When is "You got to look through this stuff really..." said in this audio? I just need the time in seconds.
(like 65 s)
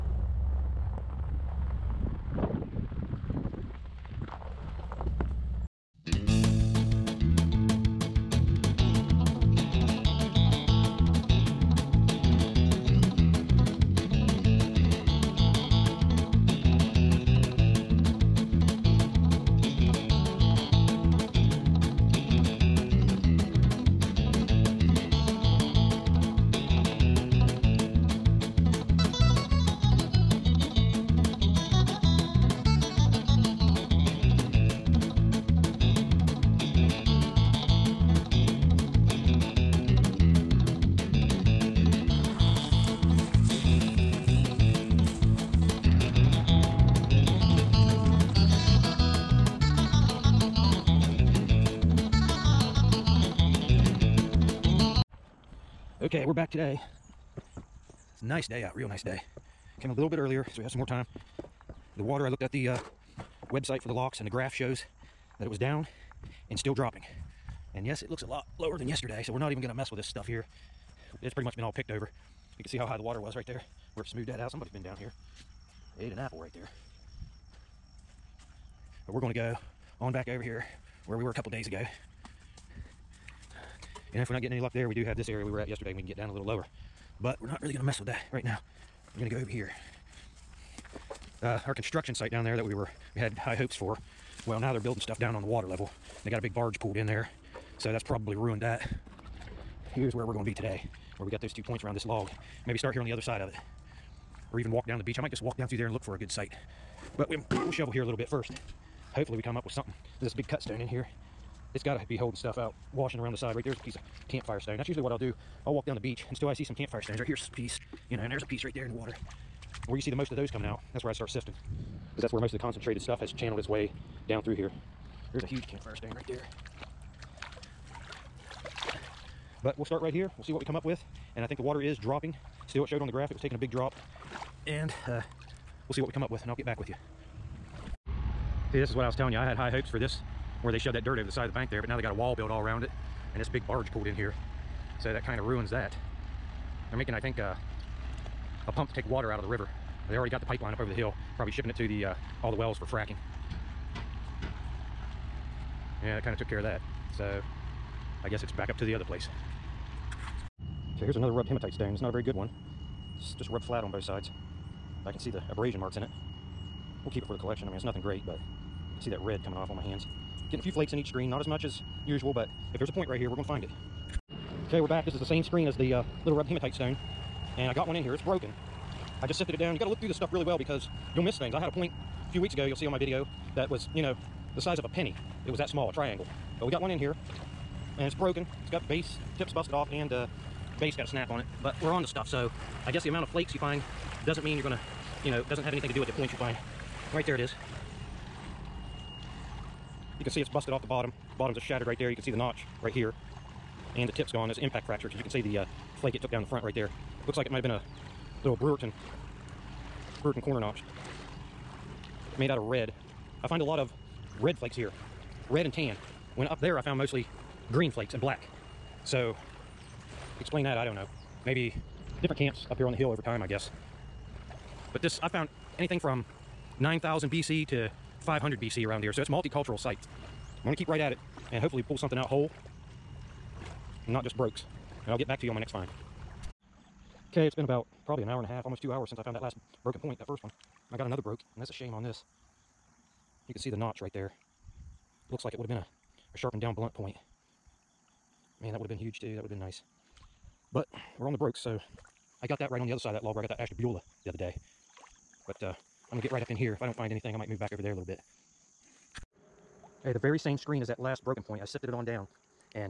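179 s.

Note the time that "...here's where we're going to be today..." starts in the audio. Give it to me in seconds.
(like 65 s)
99 s.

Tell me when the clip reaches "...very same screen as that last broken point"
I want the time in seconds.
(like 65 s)
260 s.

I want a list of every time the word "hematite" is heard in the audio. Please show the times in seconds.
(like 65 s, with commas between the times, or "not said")
161 s, 176 s.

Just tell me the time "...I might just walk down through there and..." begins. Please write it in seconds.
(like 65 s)
105 s.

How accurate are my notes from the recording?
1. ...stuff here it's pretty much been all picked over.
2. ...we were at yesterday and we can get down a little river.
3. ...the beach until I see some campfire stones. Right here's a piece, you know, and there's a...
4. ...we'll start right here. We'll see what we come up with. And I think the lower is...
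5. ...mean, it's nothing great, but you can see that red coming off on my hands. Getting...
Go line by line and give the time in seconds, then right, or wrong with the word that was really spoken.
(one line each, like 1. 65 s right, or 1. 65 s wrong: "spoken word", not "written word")
1. 70 s right
2. 85 s wrong: "lower", not "river"
3. 115 s right
4. 129 s wrong: "water", not "lower"
5. 167 s right.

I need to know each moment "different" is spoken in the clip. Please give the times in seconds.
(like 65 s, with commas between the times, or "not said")
222 s.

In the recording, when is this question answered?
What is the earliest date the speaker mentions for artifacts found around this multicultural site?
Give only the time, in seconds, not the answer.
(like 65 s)
226 s.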